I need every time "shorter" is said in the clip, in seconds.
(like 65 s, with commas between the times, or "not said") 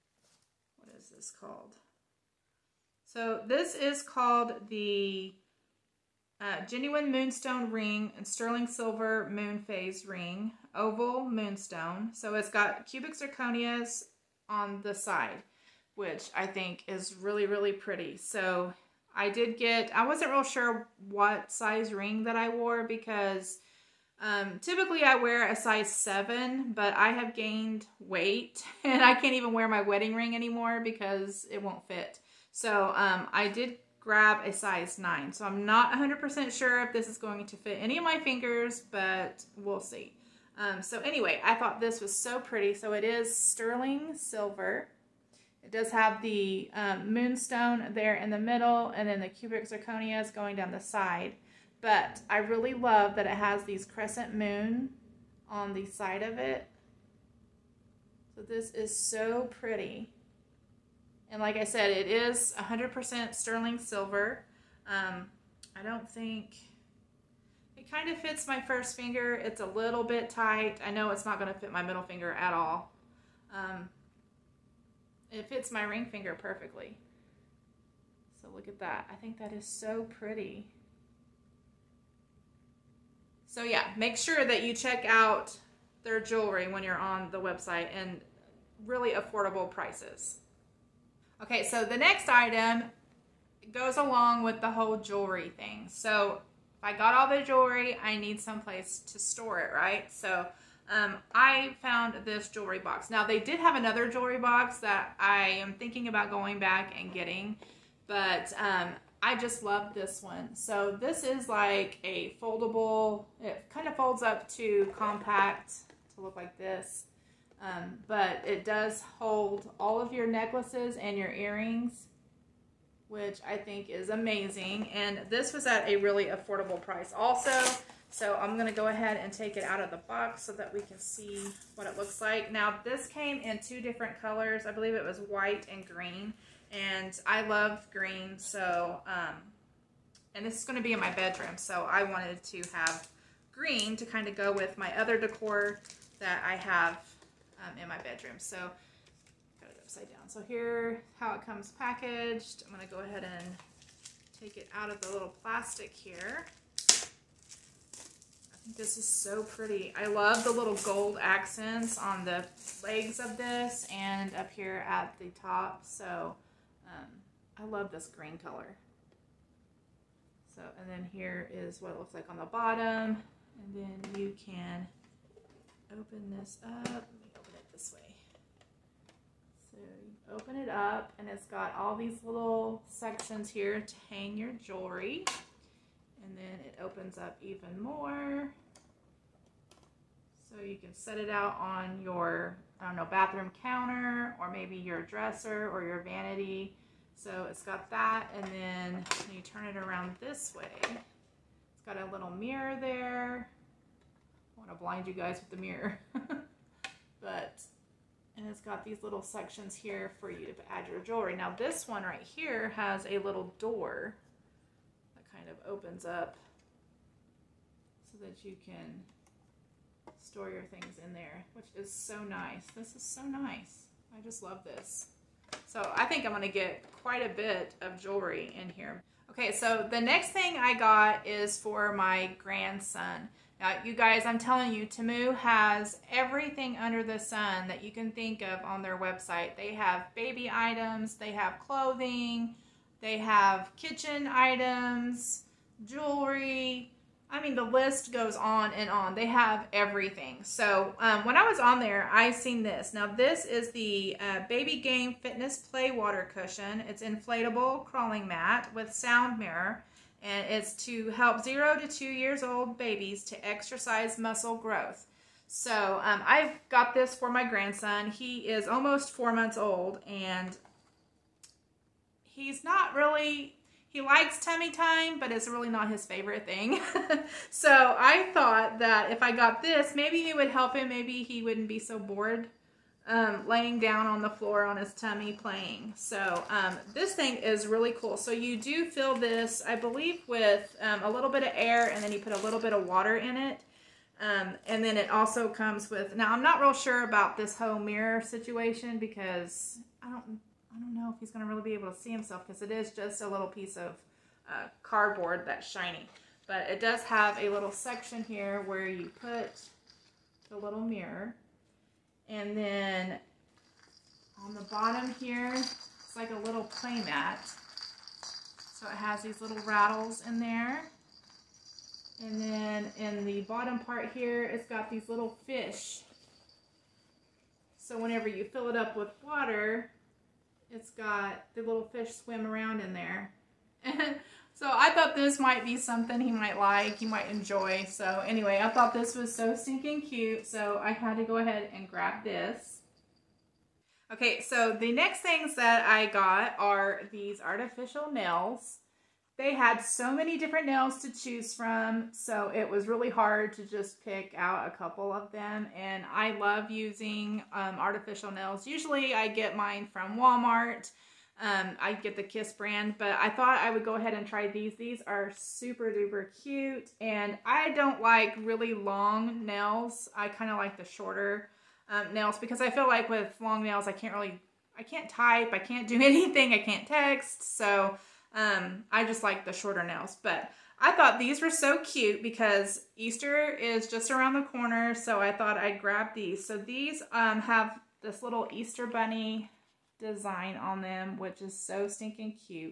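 370 s, 379 s.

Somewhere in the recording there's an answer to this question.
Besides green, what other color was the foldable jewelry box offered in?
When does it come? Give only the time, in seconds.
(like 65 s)
135 s.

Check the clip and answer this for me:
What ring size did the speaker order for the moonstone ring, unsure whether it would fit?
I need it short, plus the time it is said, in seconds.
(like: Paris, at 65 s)
9, at 34 s.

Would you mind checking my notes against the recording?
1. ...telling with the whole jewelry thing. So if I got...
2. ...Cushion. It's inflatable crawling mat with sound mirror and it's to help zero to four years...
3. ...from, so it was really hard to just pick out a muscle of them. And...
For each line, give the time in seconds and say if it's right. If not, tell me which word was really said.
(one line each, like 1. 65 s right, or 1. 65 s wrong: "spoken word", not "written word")
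1. 93 s wrong: "along", not "telling"
2. 256 s wrong: "two", not "four"
3. 351 s wrong: "couple", not "muscle".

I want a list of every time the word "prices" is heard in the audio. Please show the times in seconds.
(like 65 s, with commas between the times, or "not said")
89 s, 126 s.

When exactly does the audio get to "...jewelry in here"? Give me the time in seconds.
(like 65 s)
228 s.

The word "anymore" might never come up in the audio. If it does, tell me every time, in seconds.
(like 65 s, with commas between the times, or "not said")
30 s.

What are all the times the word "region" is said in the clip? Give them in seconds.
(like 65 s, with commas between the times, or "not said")
not said.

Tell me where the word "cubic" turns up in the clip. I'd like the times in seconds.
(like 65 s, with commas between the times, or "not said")
12 s, 49 s.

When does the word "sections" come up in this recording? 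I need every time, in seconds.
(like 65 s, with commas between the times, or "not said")
182 s, 209 s, 307 s.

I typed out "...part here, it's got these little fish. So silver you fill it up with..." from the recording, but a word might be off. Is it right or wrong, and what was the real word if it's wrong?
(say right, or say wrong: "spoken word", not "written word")
wrong: "whenever", not "silver".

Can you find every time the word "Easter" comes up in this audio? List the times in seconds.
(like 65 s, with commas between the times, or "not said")
382 s, 388 s.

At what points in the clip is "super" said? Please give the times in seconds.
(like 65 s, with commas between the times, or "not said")
365 s.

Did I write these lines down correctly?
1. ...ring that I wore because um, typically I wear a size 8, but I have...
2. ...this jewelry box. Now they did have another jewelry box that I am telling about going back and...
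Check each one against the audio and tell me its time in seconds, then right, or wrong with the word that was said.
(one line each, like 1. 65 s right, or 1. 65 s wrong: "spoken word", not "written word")
1. 21 s wrong: "7", not "8"
2. 102 s wrong: "thinking", not "telling".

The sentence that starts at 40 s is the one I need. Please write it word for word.
Um, so anyway, I thought this was so pretty.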